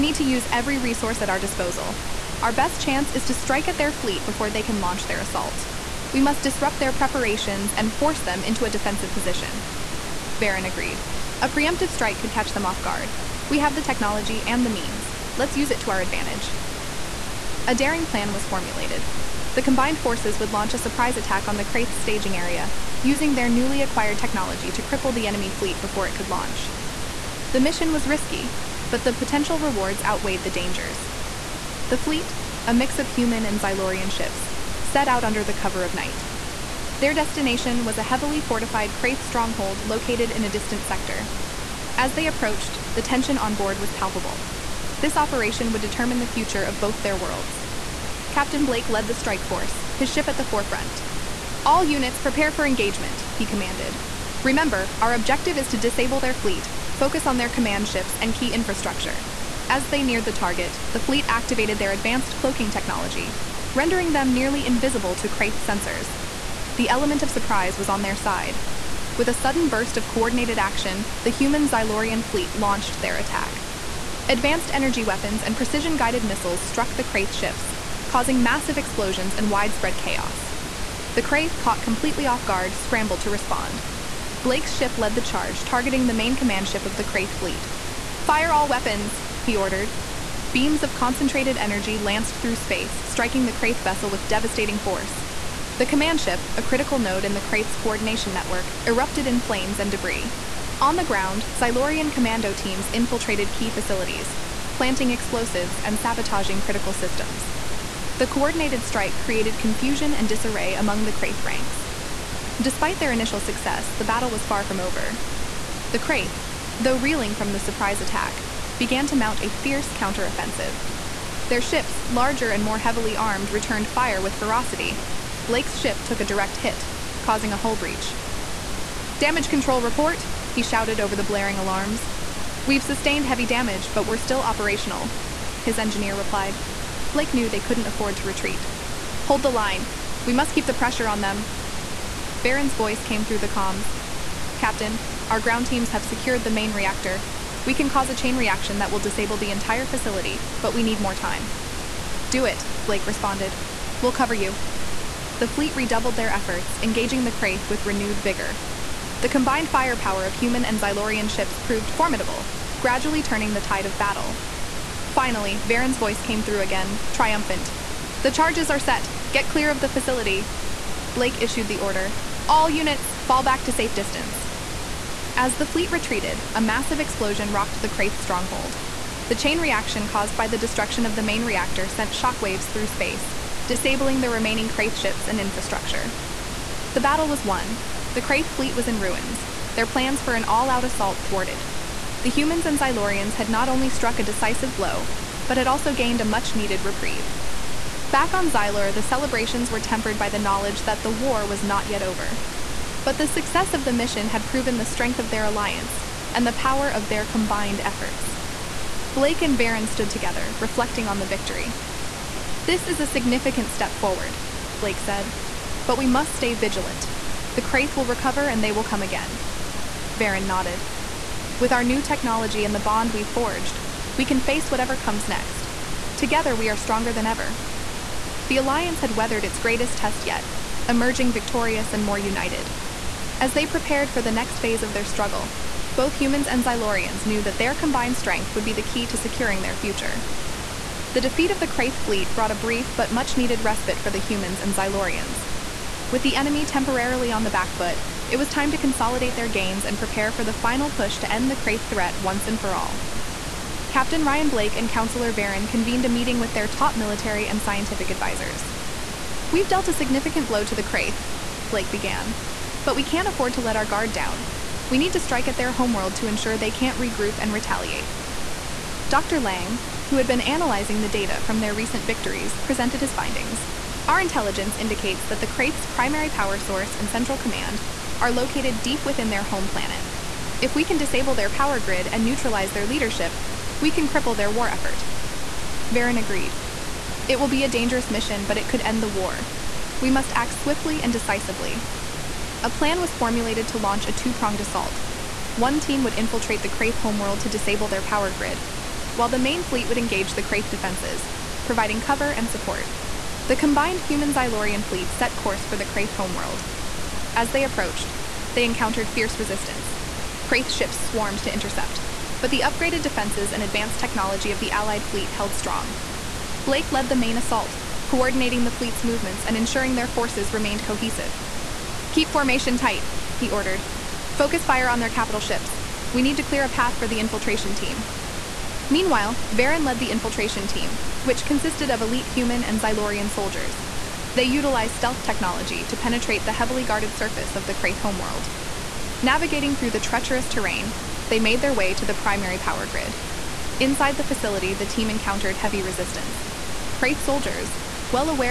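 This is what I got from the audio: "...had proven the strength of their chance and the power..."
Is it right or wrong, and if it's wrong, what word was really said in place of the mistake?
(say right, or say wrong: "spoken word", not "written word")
wrong: "alliance", not "chance".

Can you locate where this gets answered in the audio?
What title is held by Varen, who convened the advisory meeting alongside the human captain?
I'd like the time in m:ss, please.
4:14.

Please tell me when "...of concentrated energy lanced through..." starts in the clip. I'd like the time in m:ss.
1:30.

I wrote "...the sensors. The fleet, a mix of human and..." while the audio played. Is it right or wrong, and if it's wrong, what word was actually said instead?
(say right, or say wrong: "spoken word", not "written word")
wrong: "dangers", not "sensors".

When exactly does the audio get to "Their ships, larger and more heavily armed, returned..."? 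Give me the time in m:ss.
2:01.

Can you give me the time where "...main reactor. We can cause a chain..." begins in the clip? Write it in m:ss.
2:26.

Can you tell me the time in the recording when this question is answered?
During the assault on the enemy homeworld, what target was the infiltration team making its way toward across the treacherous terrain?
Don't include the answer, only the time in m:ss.
5:42.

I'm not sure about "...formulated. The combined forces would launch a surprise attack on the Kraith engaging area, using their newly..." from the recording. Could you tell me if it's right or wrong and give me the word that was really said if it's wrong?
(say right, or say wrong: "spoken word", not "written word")
wrong: "staging", not "engaging".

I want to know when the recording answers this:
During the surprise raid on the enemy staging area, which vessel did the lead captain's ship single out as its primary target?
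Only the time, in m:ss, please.
1:26.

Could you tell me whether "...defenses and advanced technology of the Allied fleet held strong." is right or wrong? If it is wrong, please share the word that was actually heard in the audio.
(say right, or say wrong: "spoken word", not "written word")
right.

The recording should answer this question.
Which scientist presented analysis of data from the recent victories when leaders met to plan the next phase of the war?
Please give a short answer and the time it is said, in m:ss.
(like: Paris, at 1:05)
Dr. Lang, at 4:29.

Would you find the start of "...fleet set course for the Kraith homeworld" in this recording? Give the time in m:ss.
5:04.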